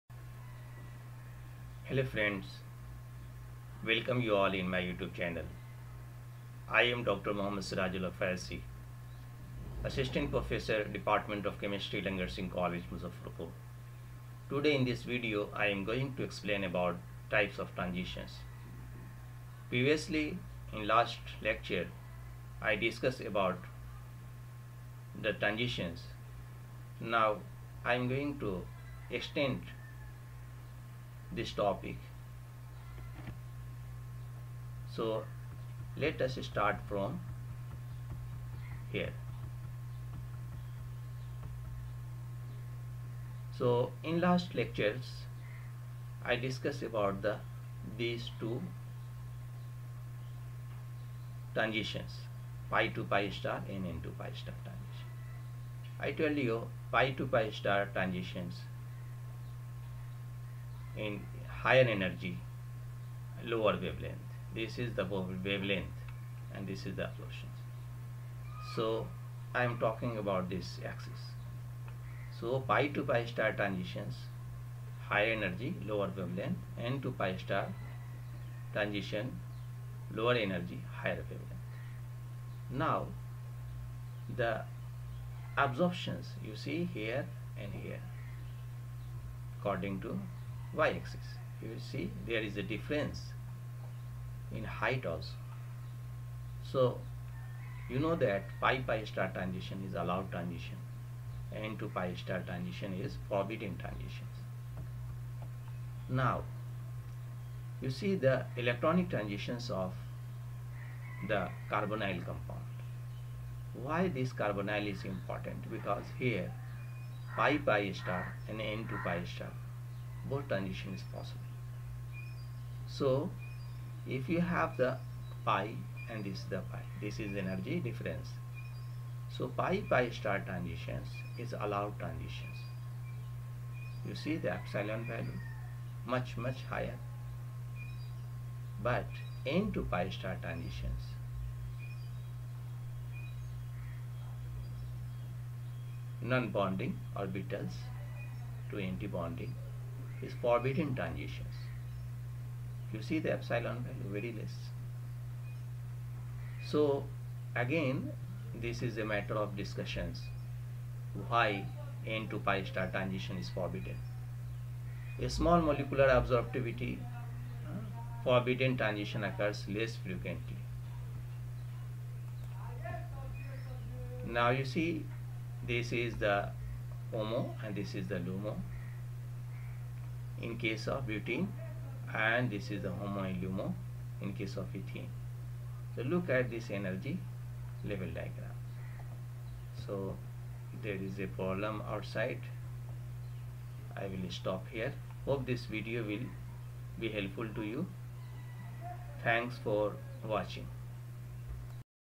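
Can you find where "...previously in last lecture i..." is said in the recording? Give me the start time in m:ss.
0:19.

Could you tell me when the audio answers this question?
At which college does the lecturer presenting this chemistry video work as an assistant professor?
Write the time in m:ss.
0:12.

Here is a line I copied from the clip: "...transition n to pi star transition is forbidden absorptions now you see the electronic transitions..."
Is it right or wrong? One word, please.
wrong.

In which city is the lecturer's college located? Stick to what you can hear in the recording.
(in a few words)
Muzaffarpur.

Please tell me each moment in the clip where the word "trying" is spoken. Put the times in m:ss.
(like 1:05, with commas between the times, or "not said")
not said.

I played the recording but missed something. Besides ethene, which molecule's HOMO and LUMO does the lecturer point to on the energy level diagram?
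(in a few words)
Butene.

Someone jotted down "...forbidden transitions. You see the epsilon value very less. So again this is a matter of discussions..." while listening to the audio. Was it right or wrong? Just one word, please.
right.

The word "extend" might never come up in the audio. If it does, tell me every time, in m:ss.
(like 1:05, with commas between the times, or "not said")
0:29.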